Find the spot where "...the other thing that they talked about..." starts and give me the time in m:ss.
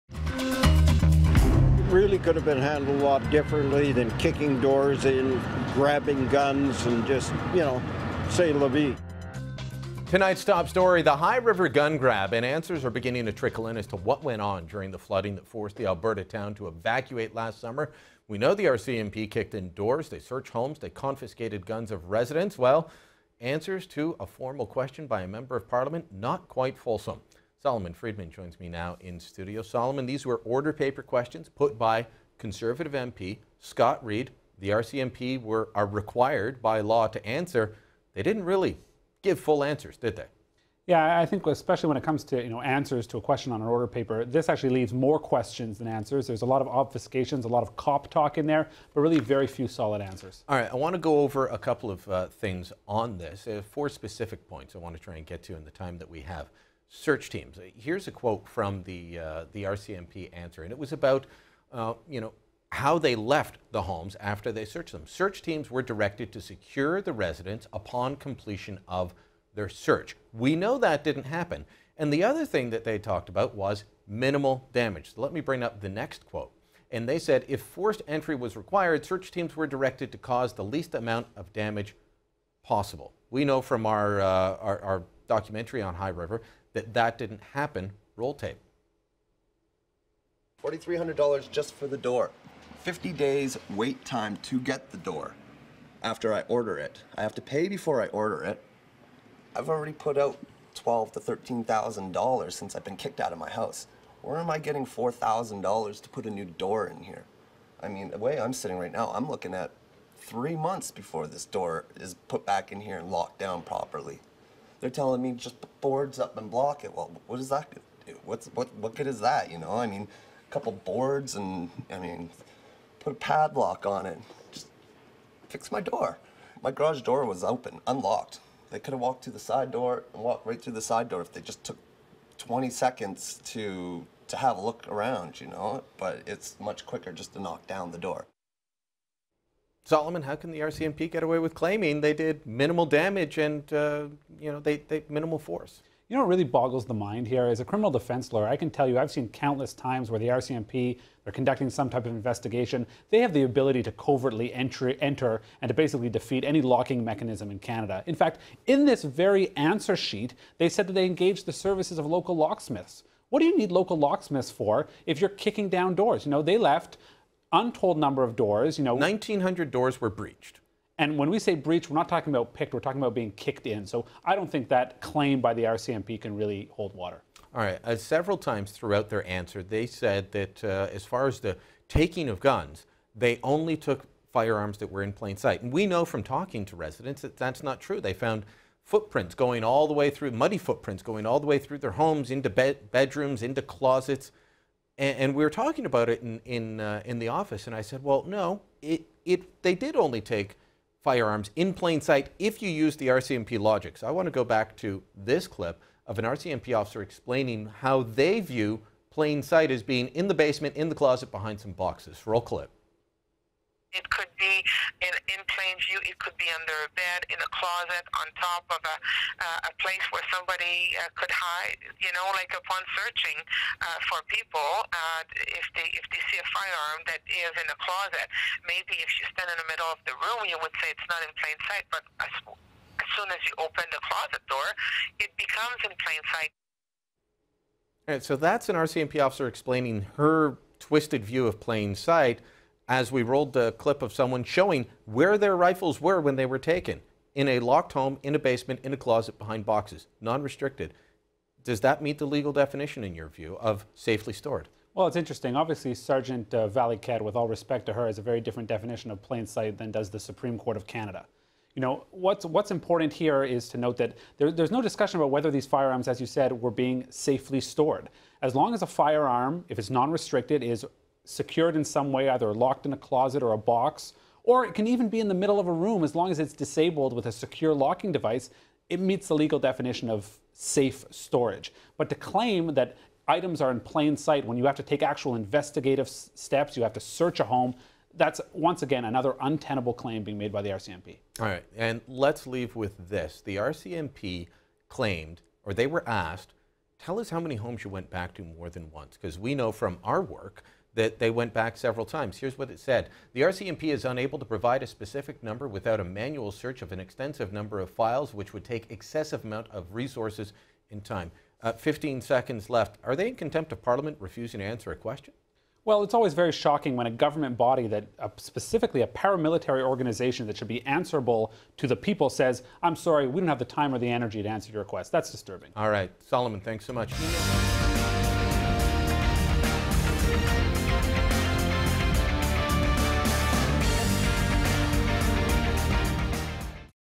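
1:12.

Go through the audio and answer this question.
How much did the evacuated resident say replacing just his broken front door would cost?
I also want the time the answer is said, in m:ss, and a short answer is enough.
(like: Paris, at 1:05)
$4,300, at 1:30.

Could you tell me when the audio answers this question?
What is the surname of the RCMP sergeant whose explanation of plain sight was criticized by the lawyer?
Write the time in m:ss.
4:16.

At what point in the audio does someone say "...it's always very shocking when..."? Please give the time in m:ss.
5:16.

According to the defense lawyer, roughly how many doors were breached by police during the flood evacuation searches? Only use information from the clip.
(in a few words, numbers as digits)
1,900.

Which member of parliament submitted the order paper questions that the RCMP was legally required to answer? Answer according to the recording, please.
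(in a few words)
Scott Reid.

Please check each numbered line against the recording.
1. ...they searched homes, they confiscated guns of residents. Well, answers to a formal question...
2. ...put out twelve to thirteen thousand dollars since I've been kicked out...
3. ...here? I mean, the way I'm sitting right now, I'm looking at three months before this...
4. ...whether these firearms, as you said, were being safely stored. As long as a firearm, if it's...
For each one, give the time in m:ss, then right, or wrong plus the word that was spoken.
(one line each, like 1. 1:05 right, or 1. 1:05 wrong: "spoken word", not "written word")
1. 0:20 right
2. 1:39 right
3. 1:47 right
4. 4:25 right.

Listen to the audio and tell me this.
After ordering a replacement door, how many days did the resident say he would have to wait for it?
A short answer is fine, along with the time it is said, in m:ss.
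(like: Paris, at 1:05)
50 days, at 1:32.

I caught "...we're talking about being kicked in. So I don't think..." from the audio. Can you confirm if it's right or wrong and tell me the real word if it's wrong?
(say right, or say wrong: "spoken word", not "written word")
right.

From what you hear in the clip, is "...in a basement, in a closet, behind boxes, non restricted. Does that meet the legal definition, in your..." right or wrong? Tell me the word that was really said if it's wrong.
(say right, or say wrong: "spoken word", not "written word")
right.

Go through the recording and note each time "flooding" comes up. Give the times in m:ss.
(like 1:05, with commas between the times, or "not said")
0:14.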